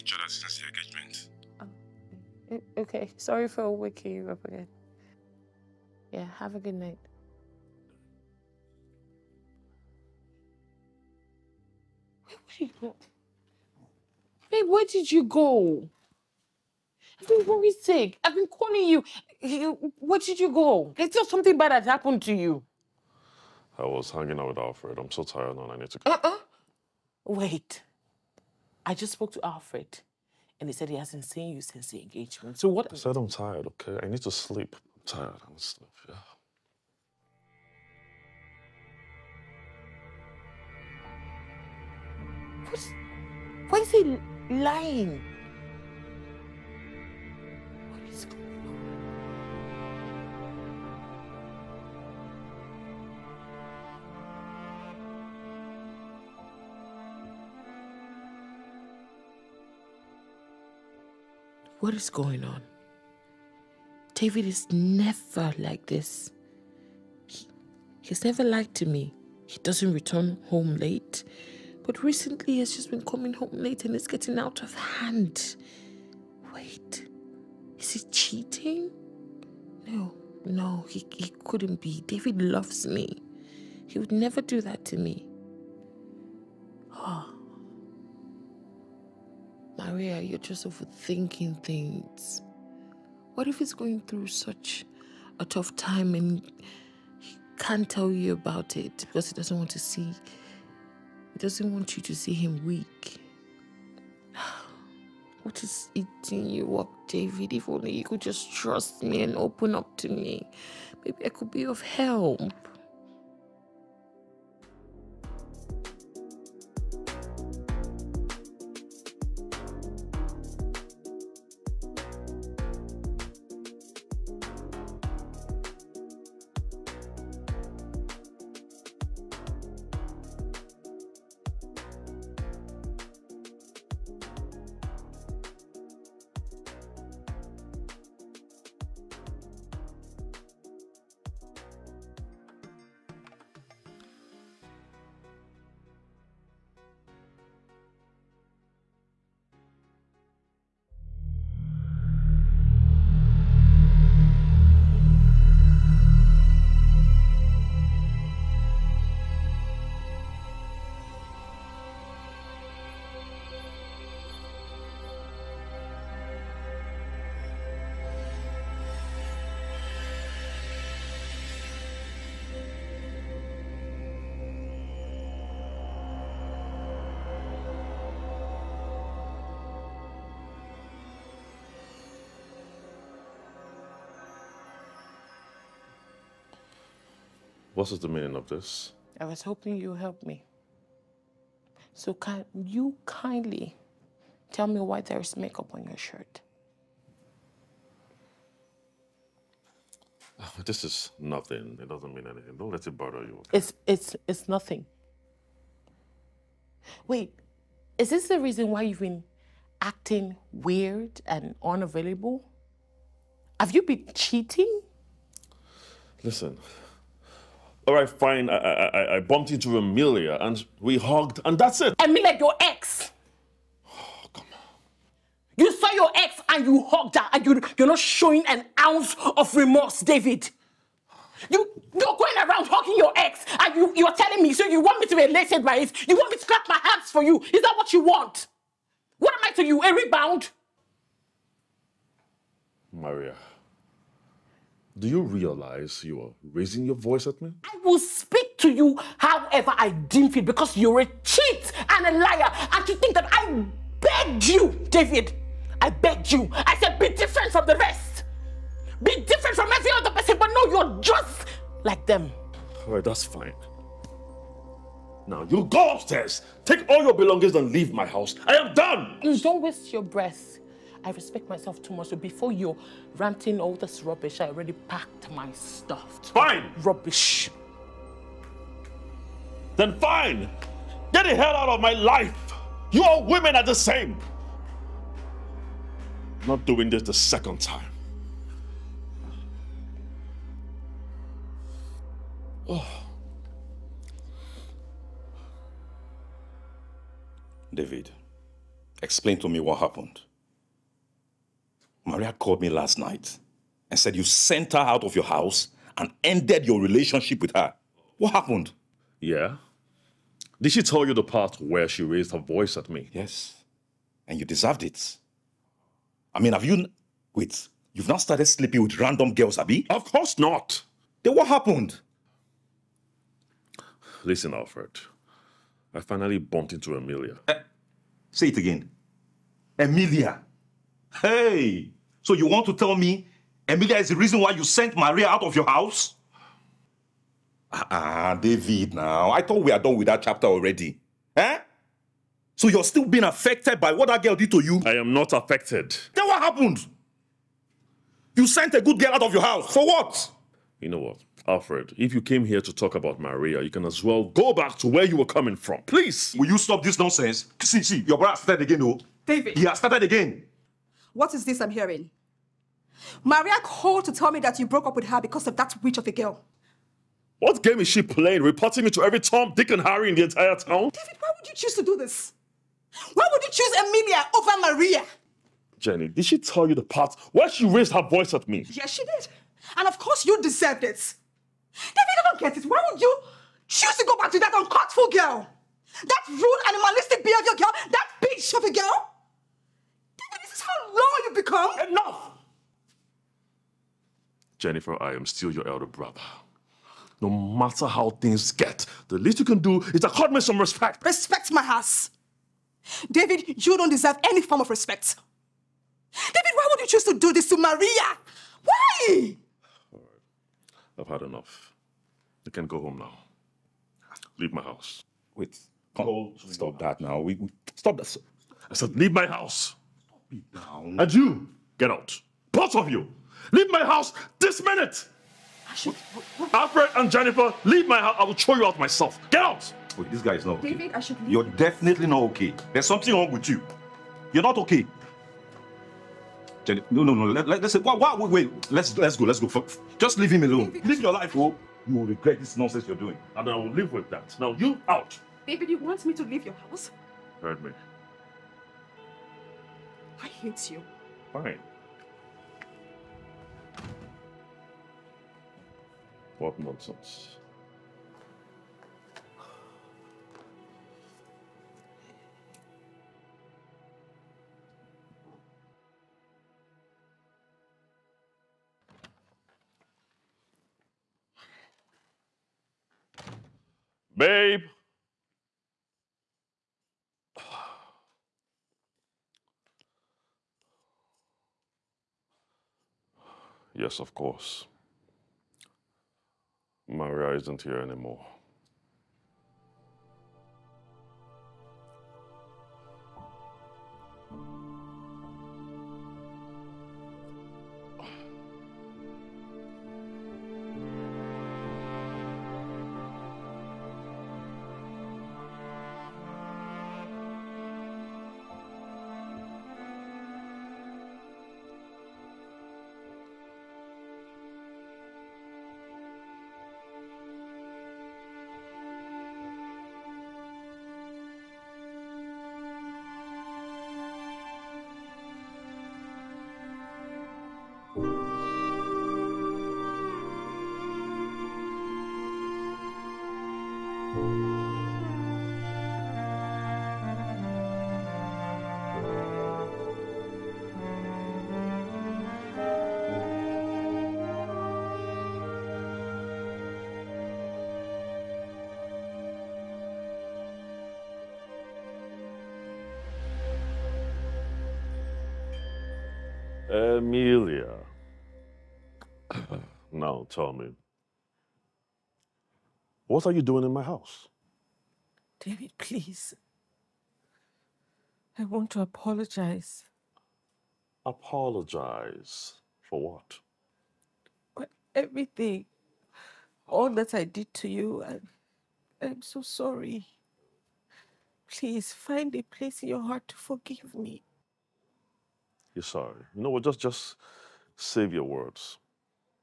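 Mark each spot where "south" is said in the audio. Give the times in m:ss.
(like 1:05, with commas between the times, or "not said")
not said.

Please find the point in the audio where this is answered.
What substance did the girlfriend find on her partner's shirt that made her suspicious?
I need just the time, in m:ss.
3:15.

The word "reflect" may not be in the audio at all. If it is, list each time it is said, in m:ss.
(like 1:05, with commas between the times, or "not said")
not said.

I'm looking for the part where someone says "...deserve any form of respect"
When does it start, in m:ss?
6:43.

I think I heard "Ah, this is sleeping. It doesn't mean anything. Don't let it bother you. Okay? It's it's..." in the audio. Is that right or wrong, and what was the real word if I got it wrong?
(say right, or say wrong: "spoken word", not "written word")
wrong: "nothing", not "sleeping".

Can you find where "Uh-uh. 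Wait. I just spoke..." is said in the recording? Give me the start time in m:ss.
0:26.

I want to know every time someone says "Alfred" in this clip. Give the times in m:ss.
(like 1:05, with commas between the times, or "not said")
0:24, 0:29, 5:24, 5:51, 7:06.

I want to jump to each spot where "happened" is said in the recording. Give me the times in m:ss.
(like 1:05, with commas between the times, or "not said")
0:21, 4:59, 5:08, 5:21, 5:46.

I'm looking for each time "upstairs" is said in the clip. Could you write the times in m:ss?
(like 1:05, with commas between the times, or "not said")
4:25.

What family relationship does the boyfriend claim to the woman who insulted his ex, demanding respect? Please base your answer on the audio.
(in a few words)
Elder brother.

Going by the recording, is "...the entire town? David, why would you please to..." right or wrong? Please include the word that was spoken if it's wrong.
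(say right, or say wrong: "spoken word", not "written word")
wrong: "choose", not "please".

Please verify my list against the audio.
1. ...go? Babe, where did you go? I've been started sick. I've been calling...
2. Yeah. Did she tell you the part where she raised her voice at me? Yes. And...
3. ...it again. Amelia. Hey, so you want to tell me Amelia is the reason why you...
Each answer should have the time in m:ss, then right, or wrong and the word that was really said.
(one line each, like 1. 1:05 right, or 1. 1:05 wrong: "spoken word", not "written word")
1. 0:12 wrong: "worried", not "started"
2. 5:09 right
3. 5:28 right.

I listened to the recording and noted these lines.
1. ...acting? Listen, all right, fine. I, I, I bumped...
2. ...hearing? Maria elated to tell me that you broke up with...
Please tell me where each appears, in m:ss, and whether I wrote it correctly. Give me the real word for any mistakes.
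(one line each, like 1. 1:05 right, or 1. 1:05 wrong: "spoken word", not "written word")
1. 3:34 wrong: "cheating", not "acting"
2. 6:01 wrong: "called", not "elated".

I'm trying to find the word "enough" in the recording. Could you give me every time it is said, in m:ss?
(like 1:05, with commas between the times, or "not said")
6:31, 6:51.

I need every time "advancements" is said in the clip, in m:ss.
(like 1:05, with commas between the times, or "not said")
not said.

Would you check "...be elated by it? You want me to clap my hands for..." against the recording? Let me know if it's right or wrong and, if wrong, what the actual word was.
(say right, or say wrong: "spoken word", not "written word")
right.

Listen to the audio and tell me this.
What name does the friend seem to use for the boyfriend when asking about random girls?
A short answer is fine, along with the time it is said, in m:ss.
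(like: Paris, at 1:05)
Abby, at 5:19.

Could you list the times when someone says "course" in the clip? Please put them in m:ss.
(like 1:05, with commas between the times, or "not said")
5:20, 6:19, 8:04.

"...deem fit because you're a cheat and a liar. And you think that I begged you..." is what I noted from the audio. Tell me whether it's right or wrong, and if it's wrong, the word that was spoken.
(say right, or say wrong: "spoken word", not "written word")
right.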